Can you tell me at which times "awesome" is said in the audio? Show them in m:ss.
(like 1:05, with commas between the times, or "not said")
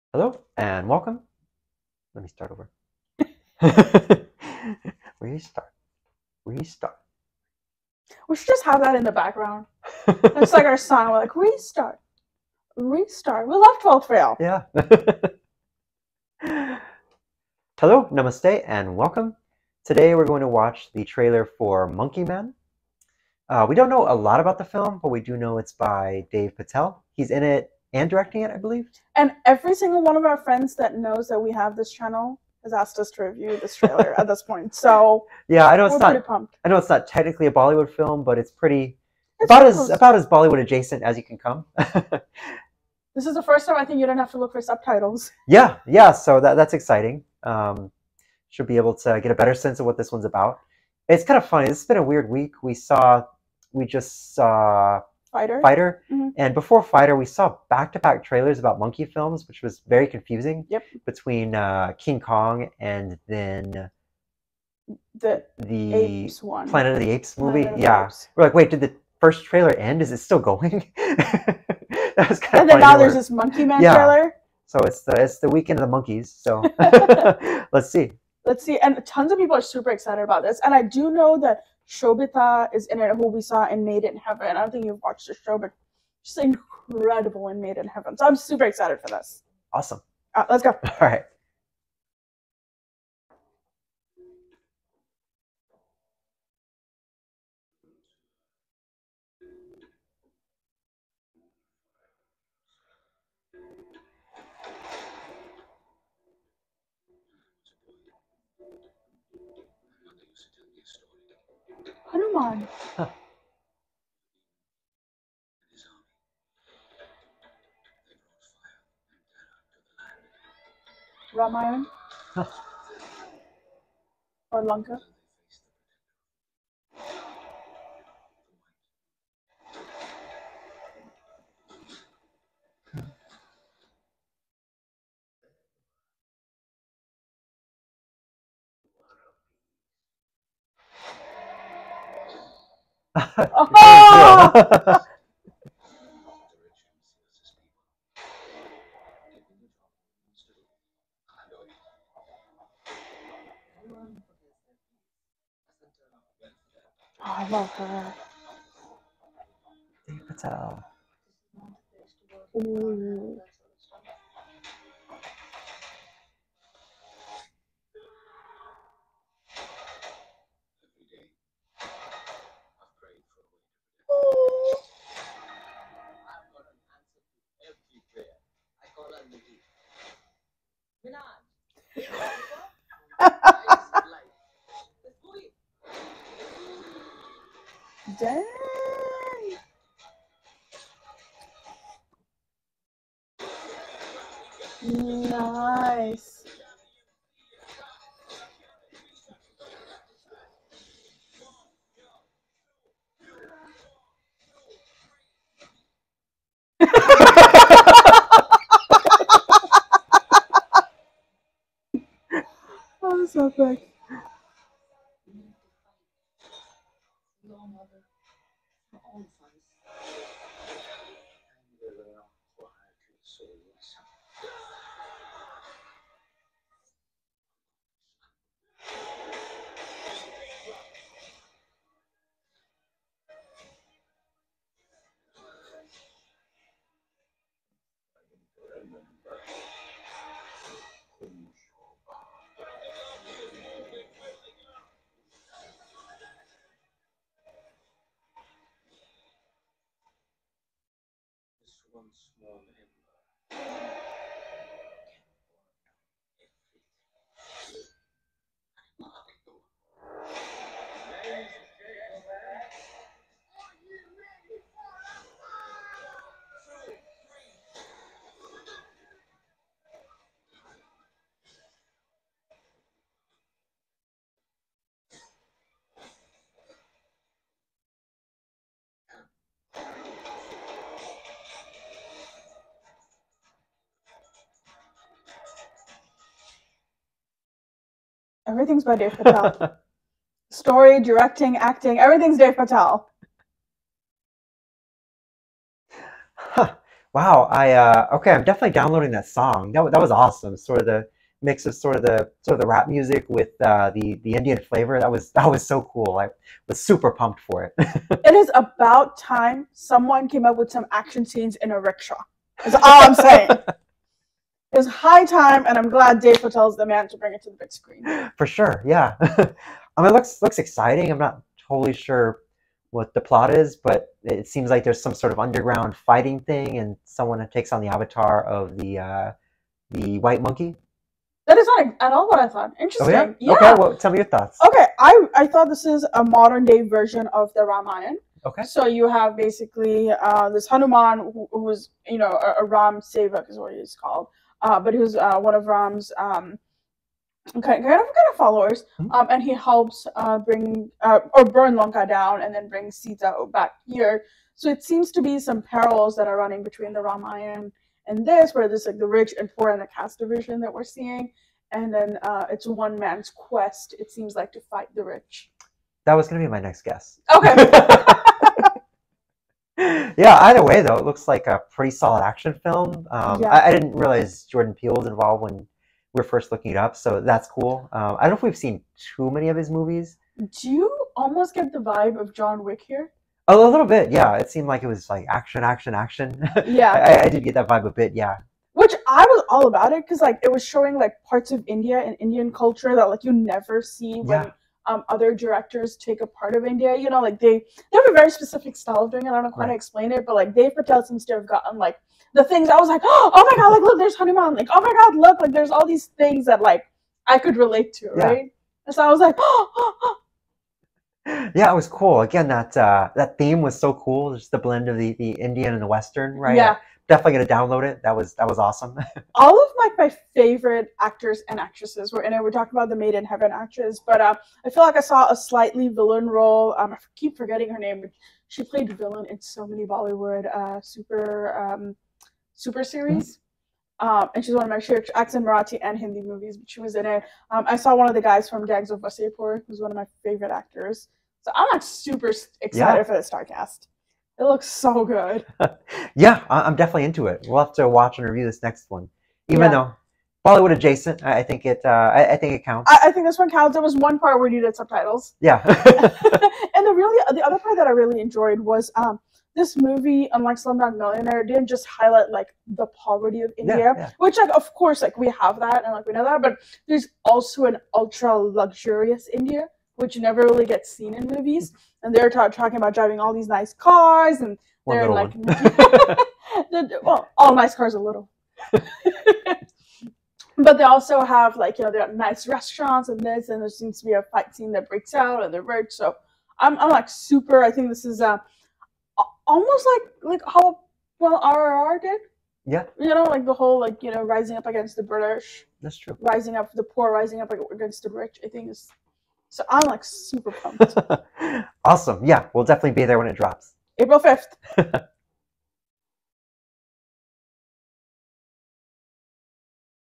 1:29, 5:00, 6:58, 8:21.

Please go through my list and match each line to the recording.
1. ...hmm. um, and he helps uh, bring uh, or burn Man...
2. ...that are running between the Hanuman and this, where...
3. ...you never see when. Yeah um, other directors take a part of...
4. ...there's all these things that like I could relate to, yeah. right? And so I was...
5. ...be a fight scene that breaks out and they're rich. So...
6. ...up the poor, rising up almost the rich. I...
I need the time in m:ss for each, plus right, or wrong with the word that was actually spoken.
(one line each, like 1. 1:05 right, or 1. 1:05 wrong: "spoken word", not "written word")
1. 5:48 wrong: "Lanka", not "Man"
2. 5:56 wrong: "Ramayana", not "Hanuman"
3. 6:33 right
4. 6:45 right
5. 8:04 right
6. 8:16 wrong: "against", not "almost".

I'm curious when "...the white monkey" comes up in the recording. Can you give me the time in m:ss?
5:29.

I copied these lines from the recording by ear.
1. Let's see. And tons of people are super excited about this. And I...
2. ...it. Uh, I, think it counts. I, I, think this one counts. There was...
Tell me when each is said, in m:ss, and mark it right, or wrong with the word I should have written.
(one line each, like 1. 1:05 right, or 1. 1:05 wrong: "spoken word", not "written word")
1. 1:18 right
2. 7:31 right.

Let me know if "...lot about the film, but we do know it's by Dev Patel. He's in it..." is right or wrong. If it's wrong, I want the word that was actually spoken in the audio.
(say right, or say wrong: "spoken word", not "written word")
right.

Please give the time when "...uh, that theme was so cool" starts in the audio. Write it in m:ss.
6:52.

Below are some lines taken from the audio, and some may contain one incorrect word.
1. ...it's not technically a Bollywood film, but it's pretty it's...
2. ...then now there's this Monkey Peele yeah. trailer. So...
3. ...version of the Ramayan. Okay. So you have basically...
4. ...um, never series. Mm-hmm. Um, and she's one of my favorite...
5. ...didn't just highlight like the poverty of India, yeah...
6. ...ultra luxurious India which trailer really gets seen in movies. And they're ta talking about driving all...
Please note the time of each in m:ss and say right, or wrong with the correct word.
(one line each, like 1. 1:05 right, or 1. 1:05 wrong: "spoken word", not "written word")
1. 0:36 right
2. 1:12 wrong: "Man", not "Peele"
3. 5:36 right
4. 7:11 wrong: "super", not "never"
5. 7:41 right
6. 7:47 wrong: "never", not "trailer".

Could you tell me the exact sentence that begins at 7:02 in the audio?
We're talking about the Made in Heaven actress, but uh, I feel like I saw a slightly villain role.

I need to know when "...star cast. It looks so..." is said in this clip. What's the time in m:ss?
7:23.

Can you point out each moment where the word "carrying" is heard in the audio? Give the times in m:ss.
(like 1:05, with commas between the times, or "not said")
not said.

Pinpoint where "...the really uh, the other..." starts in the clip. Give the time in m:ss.
7:36.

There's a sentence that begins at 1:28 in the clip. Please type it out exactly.
So I'm super excited for this.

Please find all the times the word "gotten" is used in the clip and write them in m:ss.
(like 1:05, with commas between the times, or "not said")
6:41.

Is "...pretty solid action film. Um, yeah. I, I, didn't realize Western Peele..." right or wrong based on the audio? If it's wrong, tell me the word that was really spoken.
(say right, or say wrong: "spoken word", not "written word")
wrong: "Jordan", not "Western".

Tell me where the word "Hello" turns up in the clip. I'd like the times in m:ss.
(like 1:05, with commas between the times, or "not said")
0:00, 0:17.